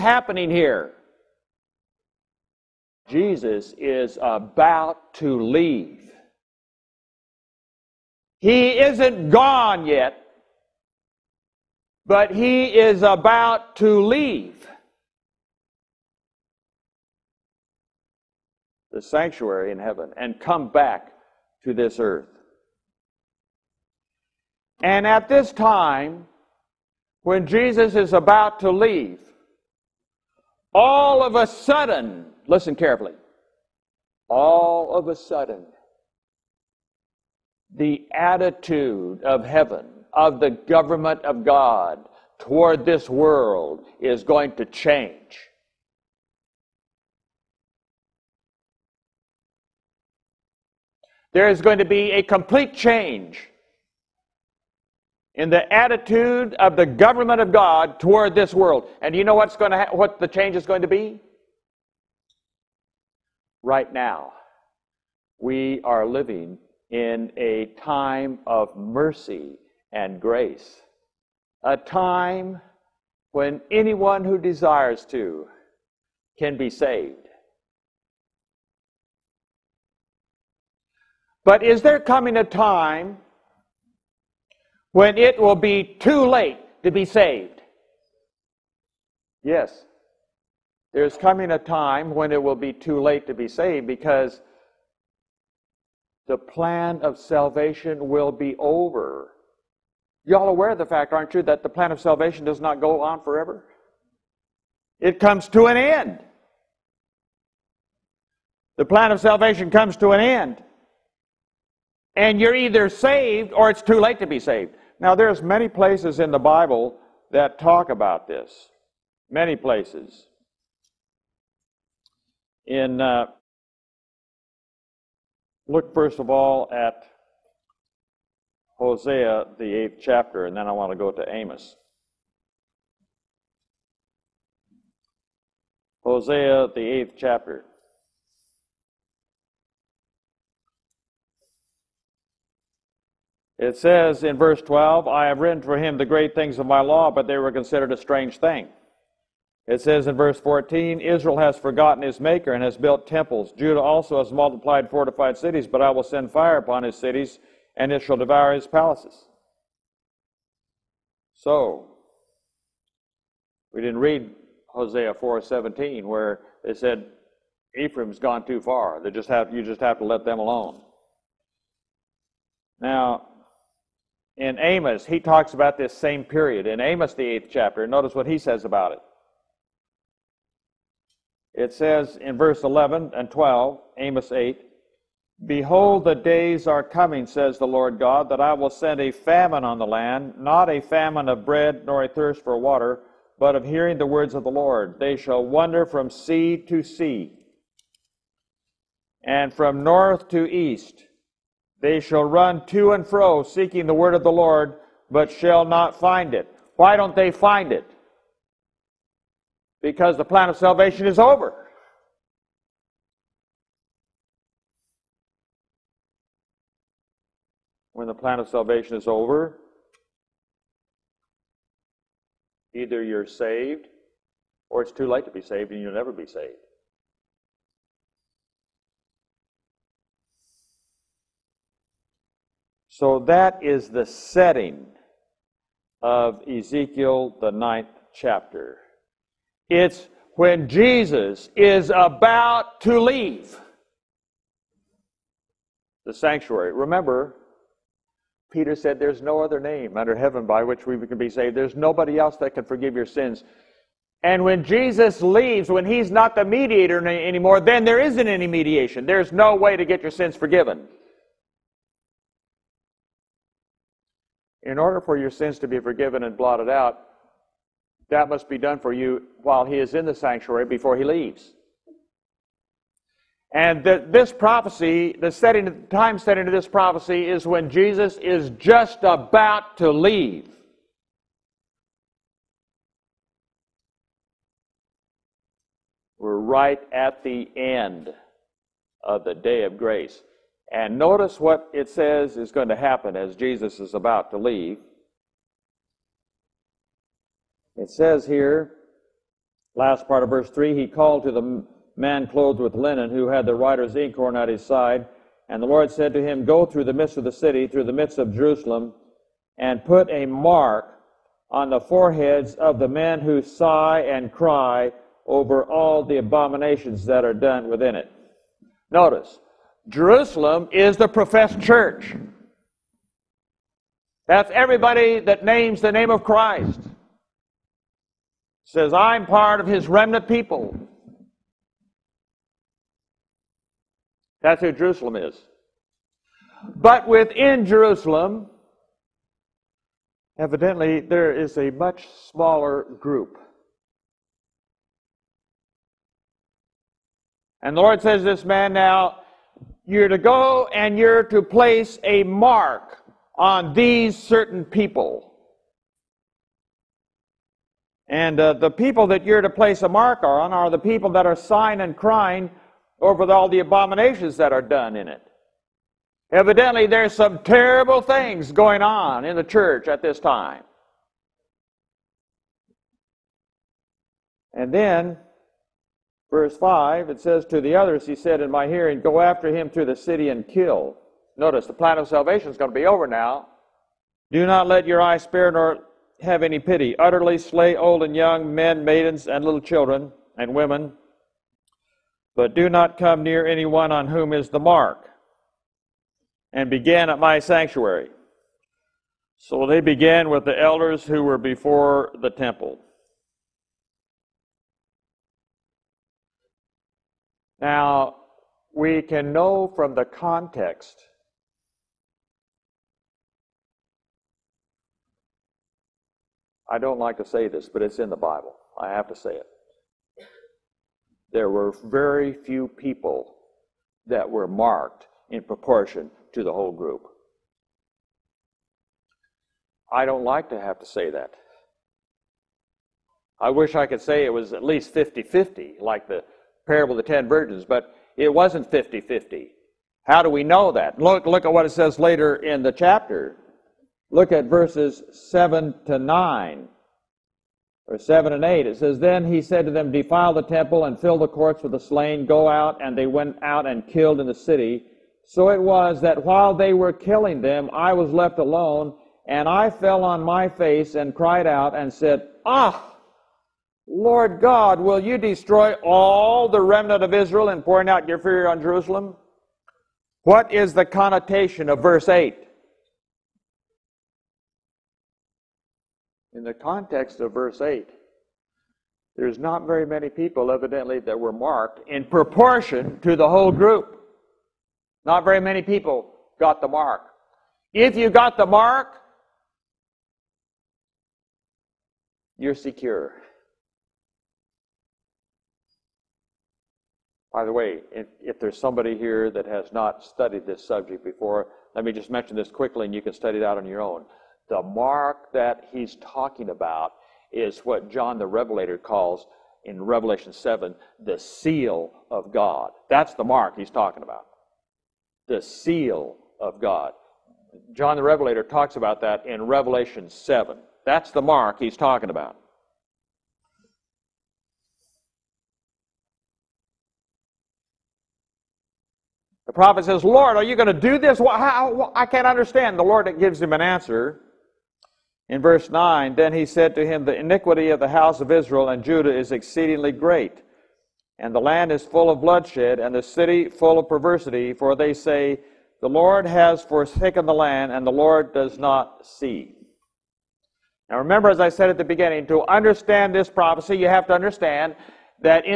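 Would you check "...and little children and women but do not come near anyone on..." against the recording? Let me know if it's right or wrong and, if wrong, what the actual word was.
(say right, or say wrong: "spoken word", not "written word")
right.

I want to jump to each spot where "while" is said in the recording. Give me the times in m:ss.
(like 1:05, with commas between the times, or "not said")
4:29, 7:36.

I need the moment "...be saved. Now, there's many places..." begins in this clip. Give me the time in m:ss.
1:54.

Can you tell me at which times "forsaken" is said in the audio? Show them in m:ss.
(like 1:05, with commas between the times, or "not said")
9:06.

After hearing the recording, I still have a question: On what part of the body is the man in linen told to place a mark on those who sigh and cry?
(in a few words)
Foreheads.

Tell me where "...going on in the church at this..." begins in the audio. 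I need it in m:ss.
6:08.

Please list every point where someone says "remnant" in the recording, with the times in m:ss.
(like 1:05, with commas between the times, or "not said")
5:29, 7:46.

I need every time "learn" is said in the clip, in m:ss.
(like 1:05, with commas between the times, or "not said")
not said.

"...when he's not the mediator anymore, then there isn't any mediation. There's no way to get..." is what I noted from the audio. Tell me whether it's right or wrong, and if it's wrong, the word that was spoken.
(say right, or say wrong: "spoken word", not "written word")
right.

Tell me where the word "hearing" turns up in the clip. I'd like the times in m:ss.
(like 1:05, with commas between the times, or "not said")
3:13, 6:18.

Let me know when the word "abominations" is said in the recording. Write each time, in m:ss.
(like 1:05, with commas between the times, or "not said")
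5:16, 6:03.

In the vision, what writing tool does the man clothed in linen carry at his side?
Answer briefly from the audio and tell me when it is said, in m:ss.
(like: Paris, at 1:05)
Writer's inkhorn, at 5:03.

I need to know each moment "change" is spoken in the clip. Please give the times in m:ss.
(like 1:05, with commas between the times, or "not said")
0:44, 0:52, 1:00.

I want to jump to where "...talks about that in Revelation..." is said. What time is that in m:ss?
8:38.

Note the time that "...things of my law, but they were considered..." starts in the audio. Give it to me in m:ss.
2:26.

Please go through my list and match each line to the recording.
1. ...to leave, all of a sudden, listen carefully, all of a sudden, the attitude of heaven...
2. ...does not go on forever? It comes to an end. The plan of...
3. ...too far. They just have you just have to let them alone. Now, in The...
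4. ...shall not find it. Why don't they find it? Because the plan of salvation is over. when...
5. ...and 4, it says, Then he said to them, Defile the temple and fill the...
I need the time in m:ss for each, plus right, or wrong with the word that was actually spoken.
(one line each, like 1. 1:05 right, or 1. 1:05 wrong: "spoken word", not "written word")
1. 0:28 right
2. 1:42 right
3. 2:48 wrong: "Amos", not "The"
4. 3:25 right
5. 7:28 wrong: "8", not "4".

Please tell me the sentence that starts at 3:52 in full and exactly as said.
So that is the setting of Ezekiel, the ninth chapter.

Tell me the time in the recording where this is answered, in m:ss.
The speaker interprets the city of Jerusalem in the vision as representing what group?
5:20.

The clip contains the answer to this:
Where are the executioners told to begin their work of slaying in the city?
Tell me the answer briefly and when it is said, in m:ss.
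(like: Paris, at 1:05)
At my sanctuary, at 6:37.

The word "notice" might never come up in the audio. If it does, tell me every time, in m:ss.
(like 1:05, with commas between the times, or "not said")
2:57, 4:50, 5:18, 6:21.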